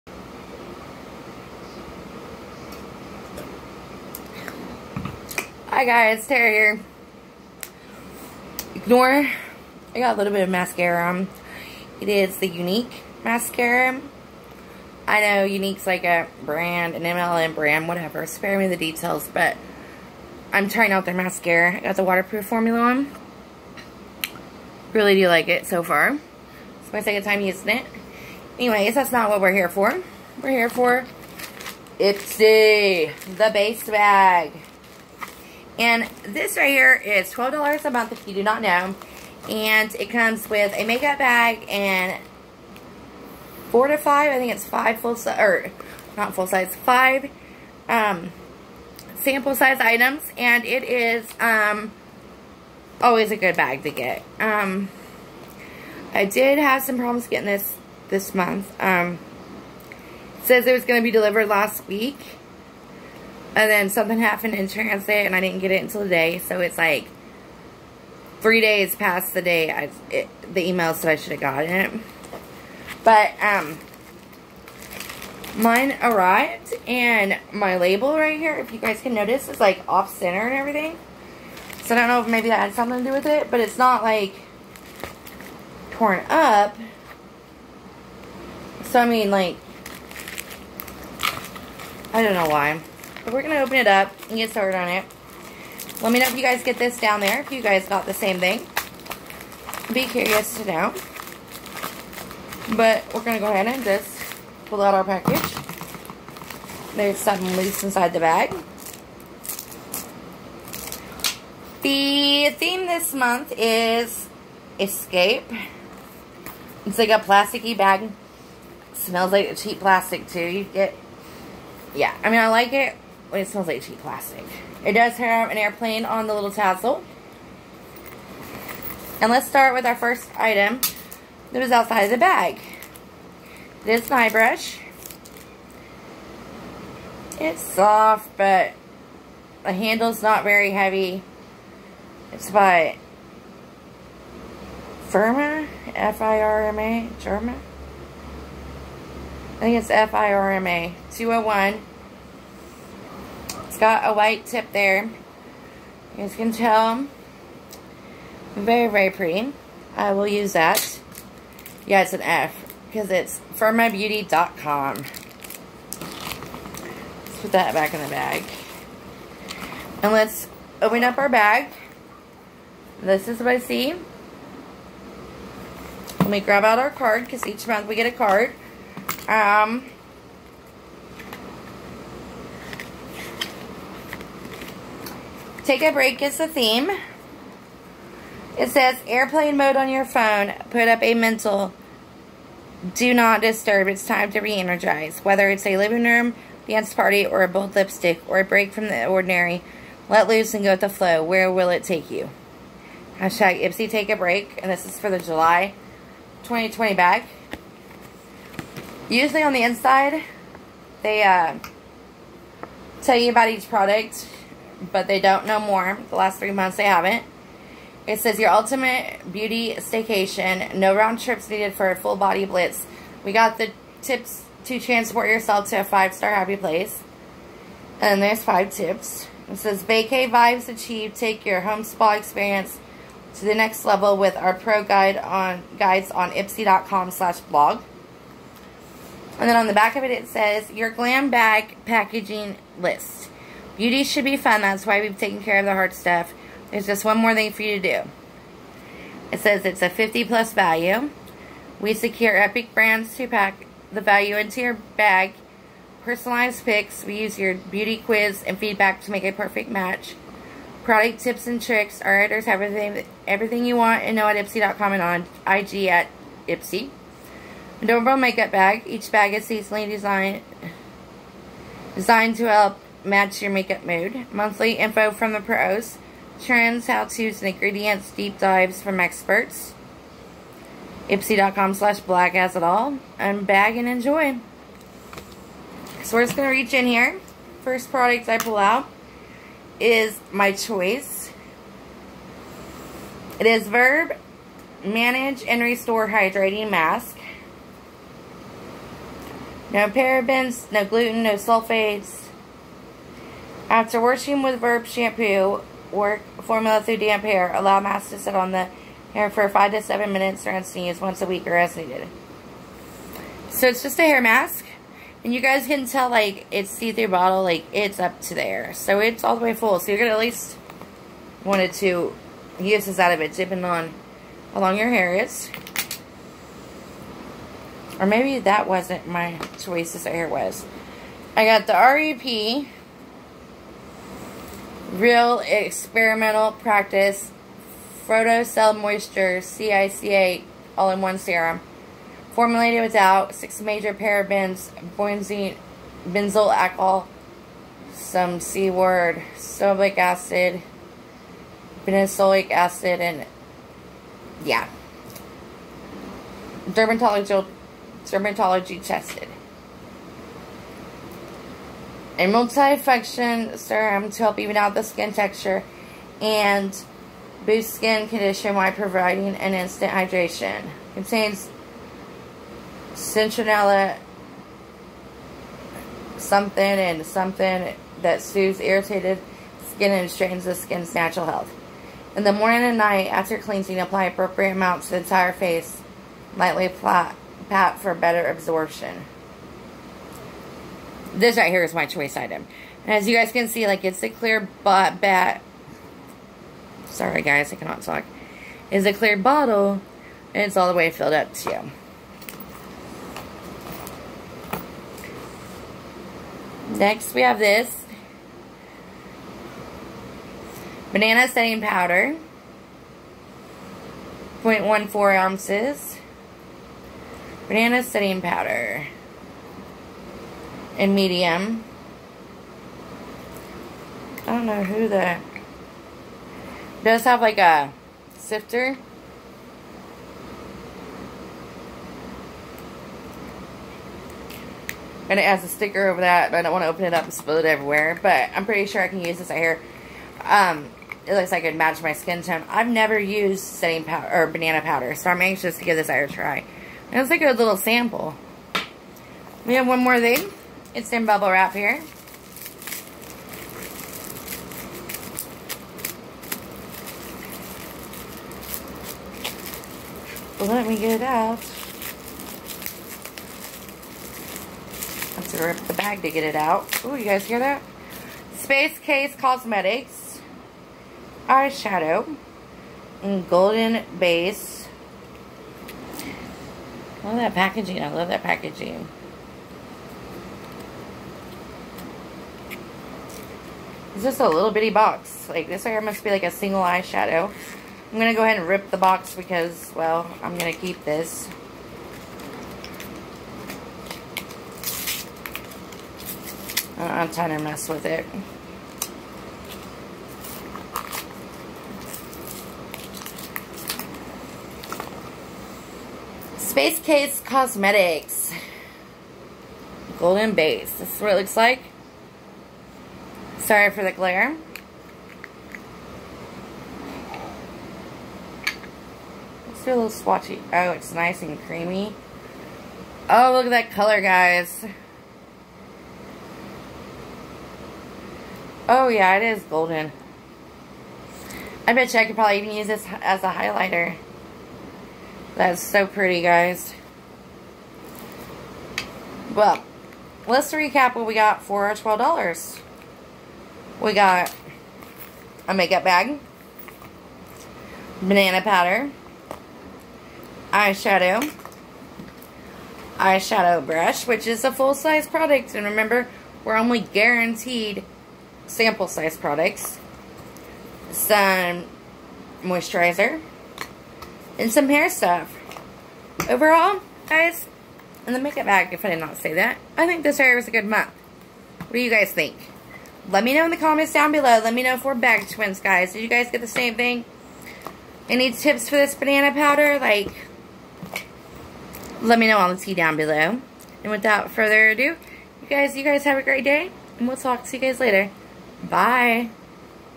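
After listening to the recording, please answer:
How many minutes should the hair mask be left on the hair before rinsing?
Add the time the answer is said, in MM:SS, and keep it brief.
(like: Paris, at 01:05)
5 to 7 minutes, at 05:09.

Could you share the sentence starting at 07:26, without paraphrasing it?
And it's like a little sample.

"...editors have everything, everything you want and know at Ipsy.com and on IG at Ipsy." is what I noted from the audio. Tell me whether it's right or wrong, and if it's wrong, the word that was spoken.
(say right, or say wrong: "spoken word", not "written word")
right.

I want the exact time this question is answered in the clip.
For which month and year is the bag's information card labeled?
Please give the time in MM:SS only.
03:25.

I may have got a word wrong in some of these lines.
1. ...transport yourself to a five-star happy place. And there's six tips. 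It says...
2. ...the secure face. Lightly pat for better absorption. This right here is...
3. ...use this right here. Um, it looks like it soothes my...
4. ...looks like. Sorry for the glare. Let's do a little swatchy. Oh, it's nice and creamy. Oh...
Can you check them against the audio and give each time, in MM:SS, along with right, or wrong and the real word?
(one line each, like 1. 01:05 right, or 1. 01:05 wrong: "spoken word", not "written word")
1. 03:44 wrong: "five", not "six"
2. 06:24 wrong: "entire", not "secure"
3. 07:19 wrong: "matches", not "soothes"
4. 08:31 right.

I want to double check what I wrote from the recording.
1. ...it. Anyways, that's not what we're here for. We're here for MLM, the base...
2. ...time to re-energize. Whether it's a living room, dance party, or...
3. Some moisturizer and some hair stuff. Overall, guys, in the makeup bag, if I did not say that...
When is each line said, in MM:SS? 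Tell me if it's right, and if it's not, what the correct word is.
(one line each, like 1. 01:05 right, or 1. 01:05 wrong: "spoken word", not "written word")
1. 00:27 wrong: "Ipsy", not "MLM"
2. 03:14 right
3. 09:20 right.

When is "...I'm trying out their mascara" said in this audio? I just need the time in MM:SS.
00:20.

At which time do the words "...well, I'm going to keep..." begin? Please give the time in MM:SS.
08:09.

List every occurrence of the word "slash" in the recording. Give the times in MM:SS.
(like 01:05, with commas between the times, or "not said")
03:57, 04:41.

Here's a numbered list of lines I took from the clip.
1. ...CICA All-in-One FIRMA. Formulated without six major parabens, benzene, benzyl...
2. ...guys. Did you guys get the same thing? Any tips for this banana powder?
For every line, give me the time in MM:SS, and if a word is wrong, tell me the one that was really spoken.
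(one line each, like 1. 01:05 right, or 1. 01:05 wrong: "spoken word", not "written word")
1. 05:39 wrong: "Serum", not "FIRMA"
2. 09:35 right.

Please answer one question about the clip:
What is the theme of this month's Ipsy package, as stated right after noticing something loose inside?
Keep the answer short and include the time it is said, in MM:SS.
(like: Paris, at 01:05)
Escape, at 01:51.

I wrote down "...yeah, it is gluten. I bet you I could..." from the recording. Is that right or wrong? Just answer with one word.
wrong.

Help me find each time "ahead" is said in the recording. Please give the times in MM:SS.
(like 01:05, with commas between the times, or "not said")
01:43, 08:08.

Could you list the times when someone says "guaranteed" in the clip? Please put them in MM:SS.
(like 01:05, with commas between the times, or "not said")
09:16.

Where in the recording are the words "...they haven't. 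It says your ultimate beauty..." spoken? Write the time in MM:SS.
03:36.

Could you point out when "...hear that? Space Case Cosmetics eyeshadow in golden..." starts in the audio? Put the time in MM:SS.
07:47.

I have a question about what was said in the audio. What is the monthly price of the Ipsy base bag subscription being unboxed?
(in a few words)
$12.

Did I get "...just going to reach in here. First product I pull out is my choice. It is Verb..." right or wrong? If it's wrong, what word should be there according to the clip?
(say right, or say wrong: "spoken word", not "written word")
right.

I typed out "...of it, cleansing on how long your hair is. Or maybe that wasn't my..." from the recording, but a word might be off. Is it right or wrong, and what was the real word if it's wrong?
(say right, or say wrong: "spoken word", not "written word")
wrong: "depending", not "cleansing".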